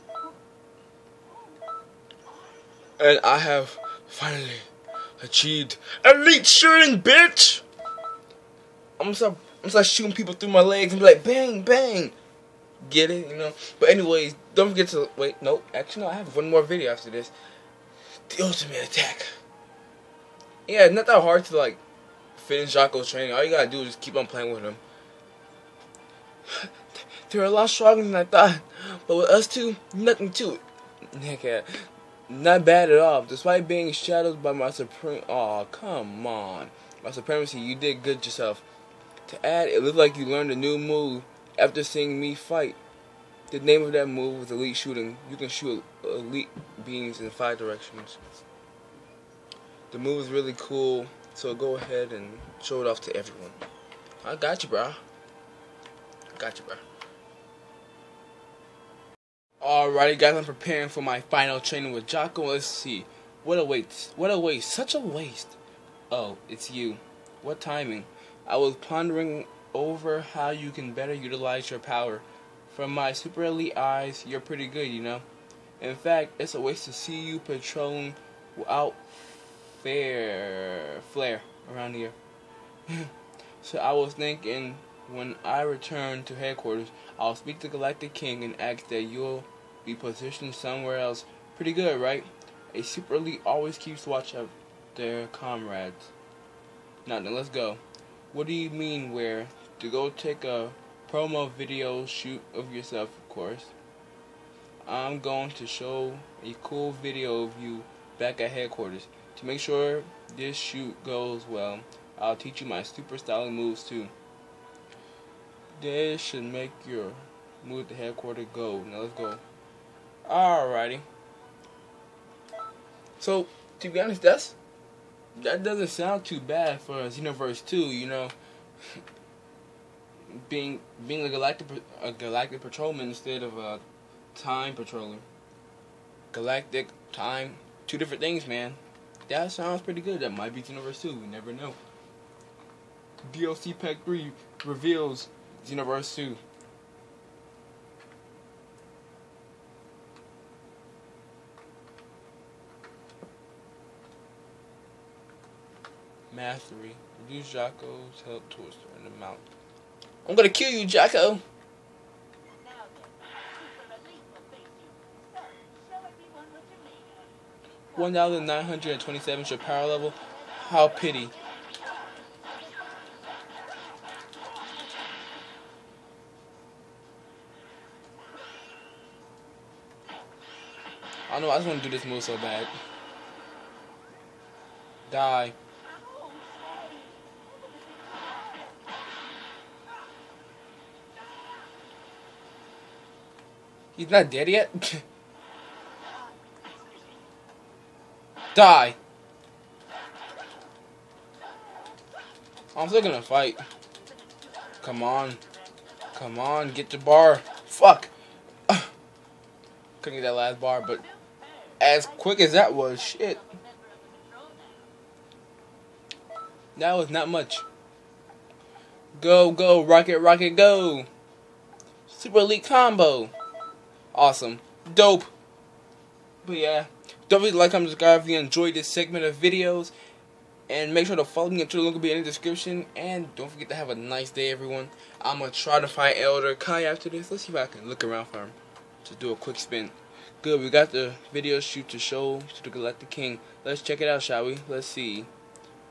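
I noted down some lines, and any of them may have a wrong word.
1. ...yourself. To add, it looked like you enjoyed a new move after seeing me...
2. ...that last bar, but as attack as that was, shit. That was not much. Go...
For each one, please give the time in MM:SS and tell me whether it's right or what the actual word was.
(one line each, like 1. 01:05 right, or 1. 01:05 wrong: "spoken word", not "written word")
1. 00:38 wrong: "learned", not "enjoyed"
2. 03:30 wrong: "quick", not "attack".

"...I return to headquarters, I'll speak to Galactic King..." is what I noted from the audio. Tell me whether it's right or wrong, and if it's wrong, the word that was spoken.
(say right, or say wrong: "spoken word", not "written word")
right.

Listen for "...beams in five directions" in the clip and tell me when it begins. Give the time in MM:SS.
00:46.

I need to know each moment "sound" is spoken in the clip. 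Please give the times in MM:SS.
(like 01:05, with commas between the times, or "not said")
02:05, 02:19.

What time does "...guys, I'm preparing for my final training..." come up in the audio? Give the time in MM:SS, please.
01:00.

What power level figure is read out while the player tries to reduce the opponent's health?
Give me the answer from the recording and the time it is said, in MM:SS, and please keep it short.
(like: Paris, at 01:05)
1927, at 02:47.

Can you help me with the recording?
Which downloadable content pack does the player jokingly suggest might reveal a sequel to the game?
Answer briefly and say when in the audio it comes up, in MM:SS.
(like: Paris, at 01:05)
DLC Pack 3, at 02:23.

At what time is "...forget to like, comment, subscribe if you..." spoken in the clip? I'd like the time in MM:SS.
03:47.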